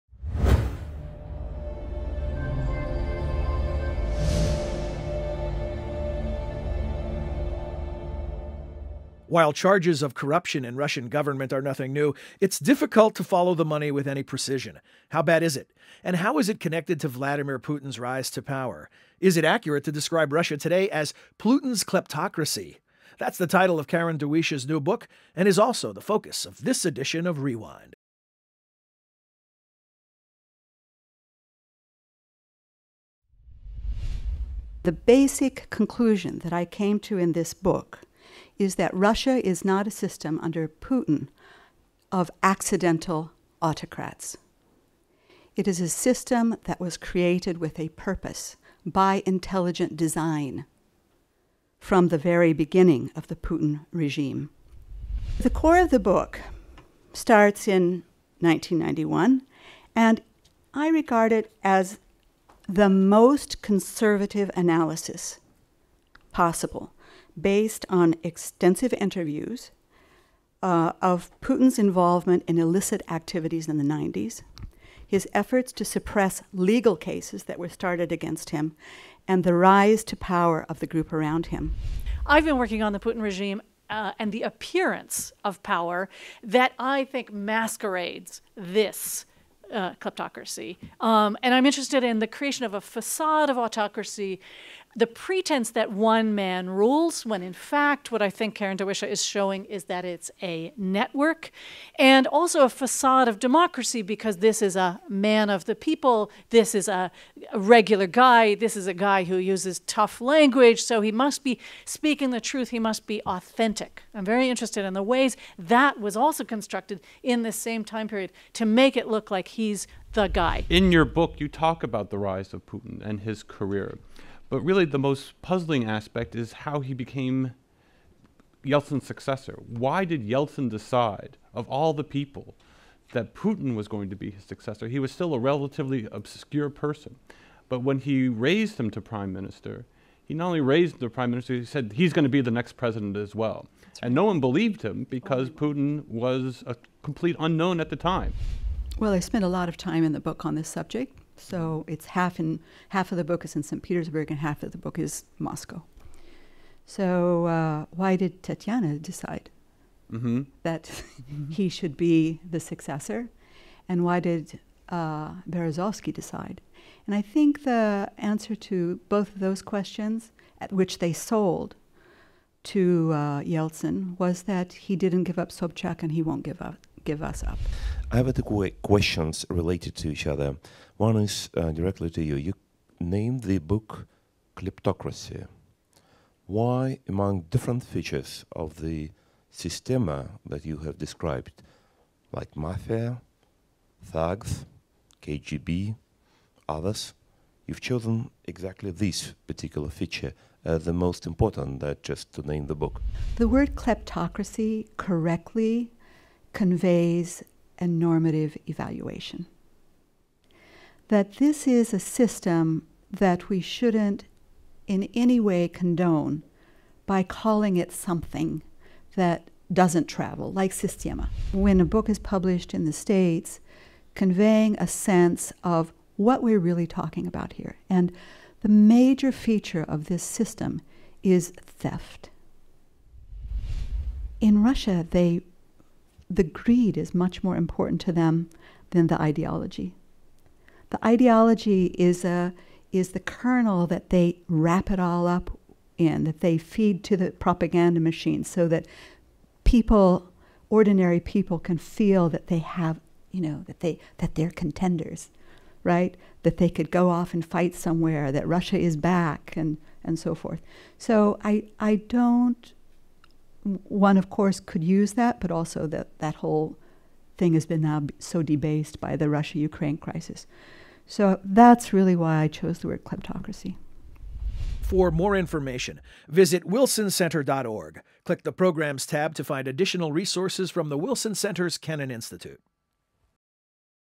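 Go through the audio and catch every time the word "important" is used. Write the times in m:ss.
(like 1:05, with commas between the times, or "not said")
3:21, 3:57.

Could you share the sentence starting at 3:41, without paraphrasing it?
When a book is published in the States, conveying a sense of what we're really talking about here.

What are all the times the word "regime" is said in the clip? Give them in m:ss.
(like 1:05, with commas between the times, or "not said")
0:53, 1:23.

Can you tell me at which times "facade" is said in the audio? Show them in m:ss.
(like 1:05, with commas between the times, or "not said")
1:32, 1:42.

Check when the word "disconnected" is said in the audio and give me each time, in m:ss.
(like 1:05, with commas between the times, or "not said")
not said.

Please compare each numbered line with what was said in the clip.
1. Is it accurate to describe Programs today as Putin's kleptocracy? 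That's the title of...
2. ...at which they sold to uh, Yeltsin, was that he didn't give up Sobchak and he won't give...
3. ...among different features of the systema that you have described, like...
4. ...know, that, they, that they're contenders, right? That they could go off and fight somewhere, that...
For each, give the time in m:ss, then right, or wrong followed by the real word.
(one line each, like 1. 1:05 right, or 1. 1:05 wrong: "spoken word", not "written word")
1. 0:19 wrong: "Russia", not "Programs"
2. 2:50 right
3. 3:07 right
4. 4:13 right.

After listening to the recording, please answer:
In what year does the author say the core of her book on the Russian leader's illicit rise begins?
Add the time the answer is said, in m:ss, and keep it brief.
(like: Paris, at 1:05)
1991, at 0:58.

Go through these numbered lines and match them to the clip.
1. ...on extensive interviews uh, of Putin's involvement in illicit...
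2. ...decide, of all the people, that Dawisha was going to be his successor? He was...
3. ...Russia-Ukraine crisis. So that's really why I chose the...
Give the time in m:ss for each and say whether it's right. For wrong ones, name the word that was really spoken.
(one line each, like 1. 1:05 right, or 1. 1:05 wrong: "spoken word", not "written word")
1. 1:07 right
2. 2:10 wrong: "Putin", not "Dawisha"
3. 4:29 right.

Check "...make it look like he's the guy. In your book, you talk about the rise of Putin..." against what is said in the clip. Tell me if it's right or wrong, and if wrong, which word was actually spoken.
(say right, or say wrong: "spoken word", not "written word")
right.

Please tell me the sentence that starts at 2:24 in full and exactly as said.
and no one believed him because Putin was a complete unknown at the time.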